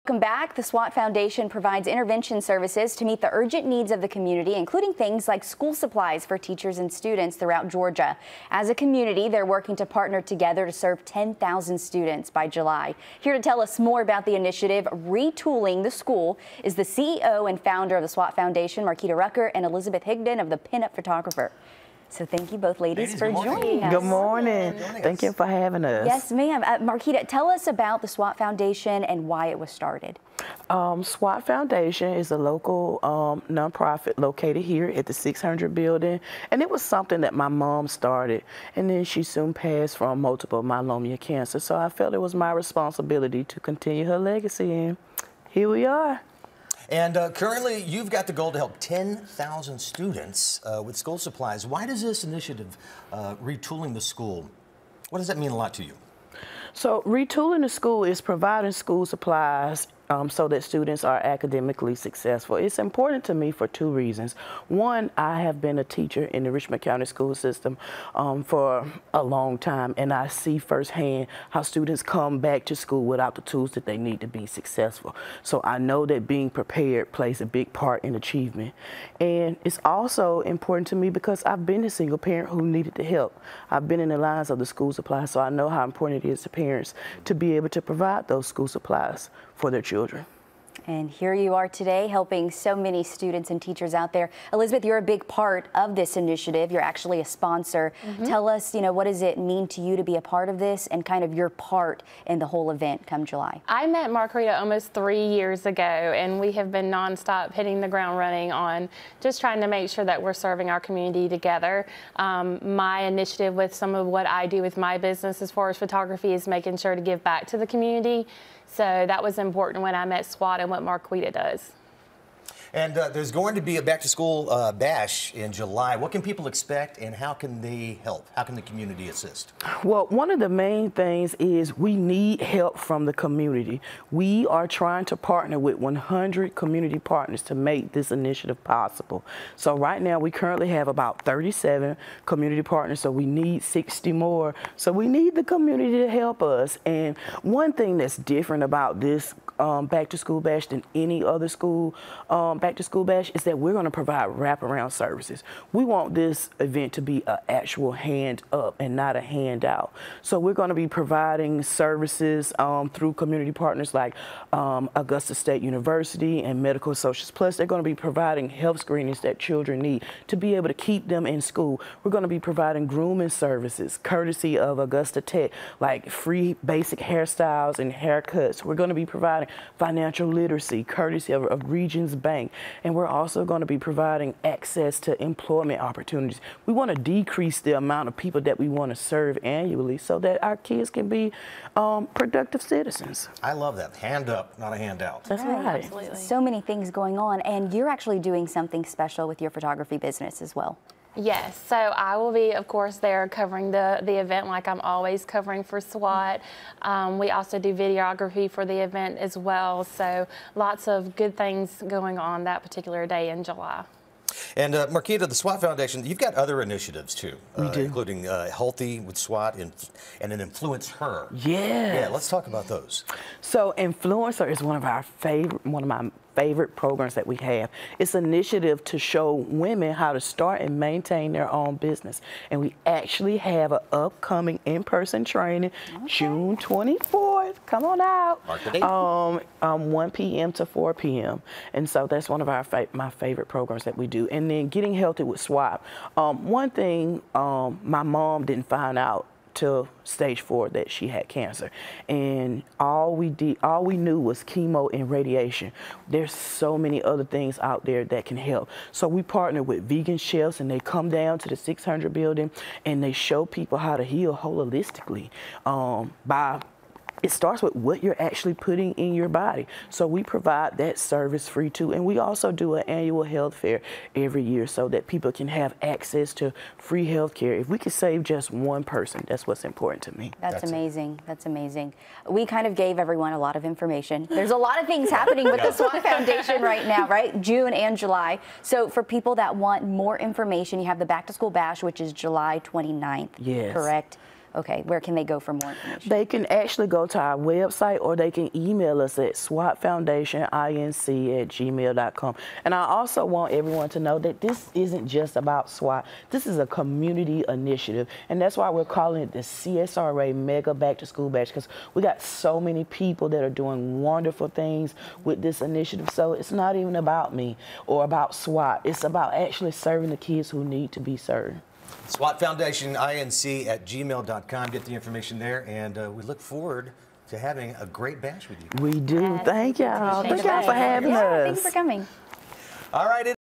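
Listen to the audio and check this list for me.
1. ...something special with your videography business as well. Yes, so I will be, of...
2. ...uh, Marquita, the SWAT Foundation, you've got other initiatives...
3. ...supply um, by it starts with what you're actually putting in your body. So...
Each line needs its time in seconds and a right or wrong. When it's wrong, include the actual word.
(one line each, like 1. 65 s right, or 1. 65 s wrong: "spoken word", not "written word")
1. 198 s wrong: "photography", not "videography"
2. 214 s right
3. 264 s wrong: "holistically", not "supply".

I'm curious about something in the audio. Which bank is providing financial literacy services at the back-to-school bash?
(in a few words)
Regions Bank.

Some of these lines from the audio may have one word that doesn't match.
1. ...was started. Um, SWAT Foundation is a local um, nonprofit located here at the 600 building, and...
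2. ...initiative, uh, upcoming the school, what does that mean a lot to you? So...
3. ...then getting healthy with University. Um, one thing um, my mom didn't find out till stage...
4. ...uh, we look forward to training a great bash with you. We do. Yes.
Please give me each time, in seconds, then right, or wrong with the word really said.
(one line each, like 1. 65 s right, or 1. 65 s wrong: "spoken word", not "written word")
1. 29 s right
2. 52 s wrong: "retooling", not "upcoming"
3. 244 s wrong: "SWAT", not "University"
4. 325 s wrong: "having", not "training".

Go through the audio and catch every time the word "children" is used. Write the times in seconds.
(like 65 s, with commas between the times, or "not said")
89 s, 169 s.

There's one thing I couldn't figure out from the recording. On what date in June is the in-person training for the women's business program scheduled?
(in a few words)
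June 24.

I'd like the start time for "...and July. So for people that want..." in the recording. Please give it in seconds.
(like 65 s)
287 s.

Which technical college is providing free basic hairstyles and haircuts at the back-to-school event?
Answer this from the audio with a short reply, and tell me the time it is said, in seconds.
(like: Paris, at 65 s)
Augusta Tech, at 174 s.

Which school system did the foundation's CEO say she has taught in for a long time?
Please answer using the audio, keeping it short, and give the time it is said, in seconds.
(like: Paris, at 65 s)
Richmond County, at 66 s.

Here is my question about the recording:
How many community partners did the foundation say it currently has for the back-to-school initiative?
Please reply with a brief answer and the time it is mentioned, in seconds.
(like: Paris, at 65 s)
37, at 141 s.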